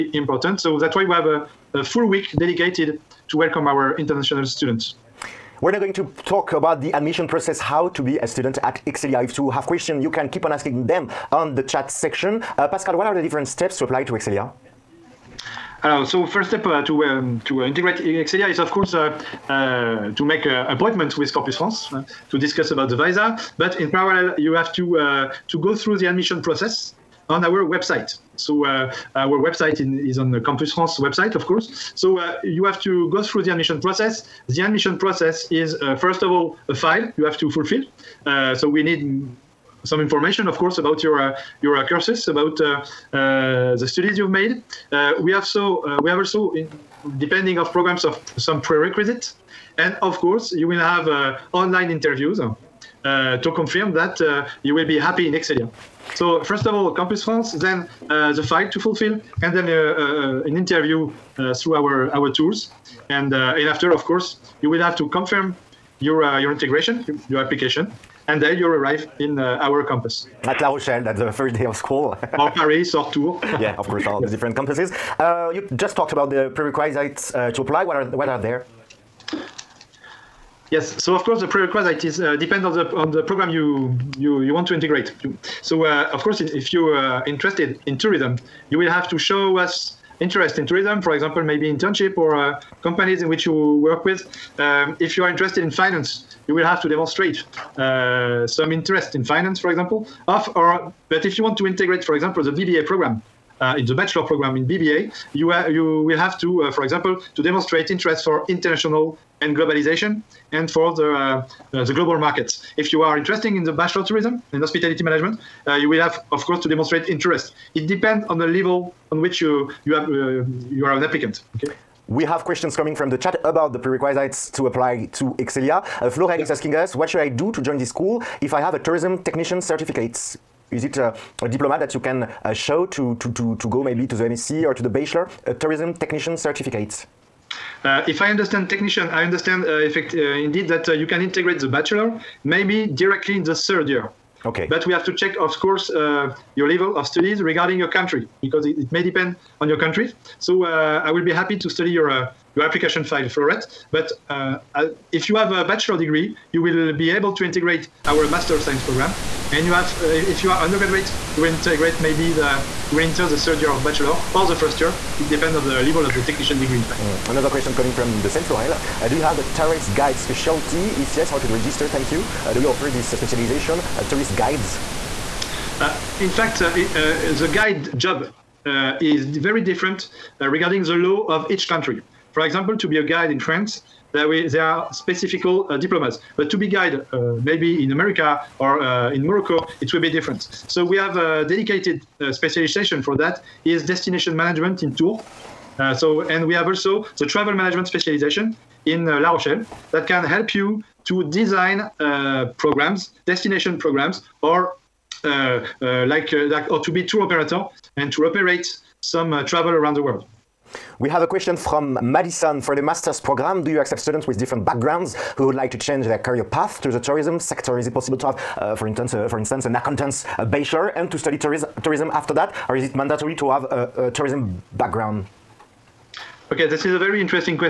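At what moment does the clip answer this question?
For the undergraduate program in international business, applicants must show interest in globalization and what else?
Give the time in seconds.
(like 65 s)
111 s.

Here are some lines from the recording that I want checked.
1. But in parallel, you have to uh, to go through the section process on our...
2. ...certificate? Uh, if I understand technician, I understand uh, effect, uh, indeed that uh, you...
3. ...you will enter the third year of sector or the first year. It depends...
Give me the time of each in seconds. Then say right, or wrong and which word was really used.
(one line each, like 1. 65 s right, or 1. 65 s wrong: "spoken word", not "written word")
1. 23 s wrong: "admission", not "section"
2. 136 s right
3. 162 s wrong: "bachelor", not "sector".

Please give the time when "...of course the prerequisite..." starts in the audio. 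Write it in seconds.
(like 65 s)
81 s.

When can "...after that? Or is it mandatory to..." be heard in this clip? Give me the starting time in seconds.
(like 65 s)
222 s.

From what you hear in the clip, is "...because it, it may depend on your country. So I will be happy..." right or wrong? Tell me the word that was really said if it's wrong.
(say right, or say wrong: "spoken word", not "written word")
right.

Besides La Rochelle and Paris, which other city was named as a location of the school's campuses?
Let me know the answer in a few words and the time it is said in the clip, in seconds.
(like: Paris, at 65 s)
Tours, at 73 s.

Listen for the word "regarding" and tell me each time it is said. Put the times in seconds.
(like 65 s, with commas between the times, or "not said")
147 s, 180 s.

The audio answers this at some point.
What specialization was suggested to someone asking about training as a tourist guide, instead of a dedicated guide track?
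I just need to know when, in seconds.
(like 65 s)
193 s.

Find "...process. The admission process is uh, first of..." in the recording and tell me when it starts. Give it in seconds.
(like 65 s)
33 s.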